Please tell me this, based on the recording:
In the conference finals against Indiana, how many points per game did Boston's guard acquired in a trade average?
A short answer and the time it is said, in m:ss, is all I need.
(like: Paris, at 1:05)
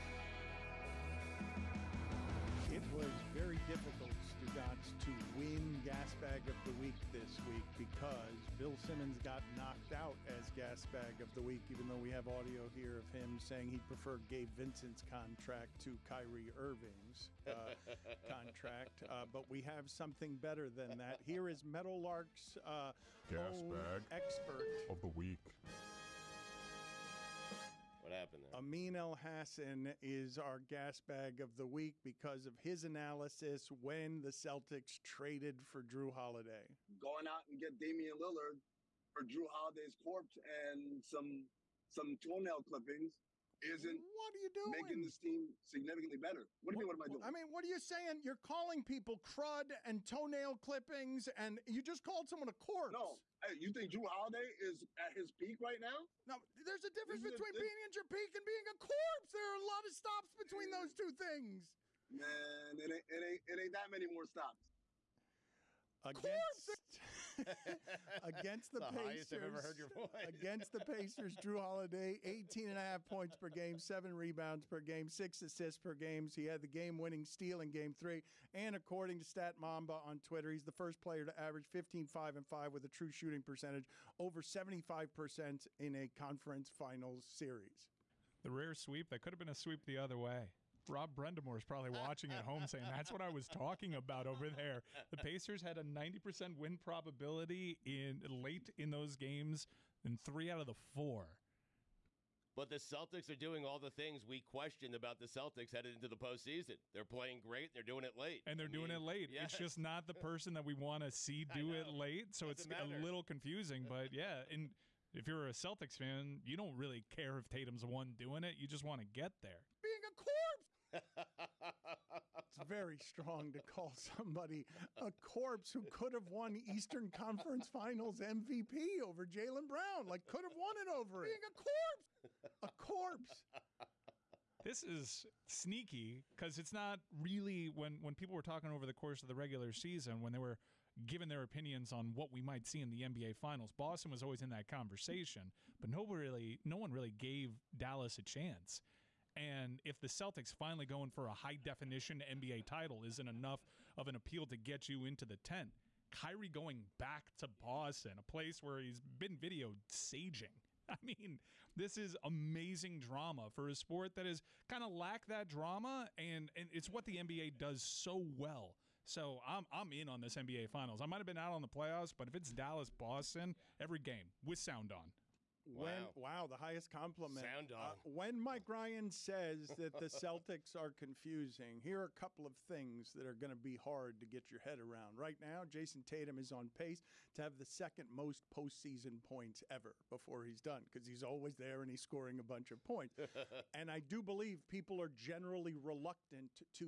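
18.5, at 1:12.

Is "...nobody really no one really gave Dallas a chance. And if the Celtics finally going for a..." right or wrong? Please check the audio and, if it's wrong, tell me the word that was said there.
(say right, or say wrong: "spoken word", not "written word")
right.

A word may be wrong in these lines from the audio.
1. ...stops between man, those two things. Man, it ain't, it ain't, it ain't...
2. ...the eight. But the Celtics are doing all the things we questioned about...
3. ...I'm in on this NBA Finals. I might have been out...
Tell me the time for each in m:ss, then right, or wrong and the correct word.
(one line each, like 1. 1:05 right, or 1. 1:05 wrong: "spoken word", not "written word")
1. 0:59 right
2. 1:40 wrong: "four", not "eight"
3. 2:49 right.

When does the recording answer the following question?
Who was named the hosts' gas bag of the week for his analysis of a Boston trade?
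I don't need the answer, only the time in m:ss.
0:28.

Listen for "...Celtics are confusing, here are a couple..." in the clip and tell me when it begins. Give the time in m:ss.
3:00.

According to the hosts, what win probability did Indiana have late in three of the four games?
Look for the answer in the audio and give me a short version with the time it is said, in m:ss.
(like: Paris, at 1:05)
90%, at 1:35.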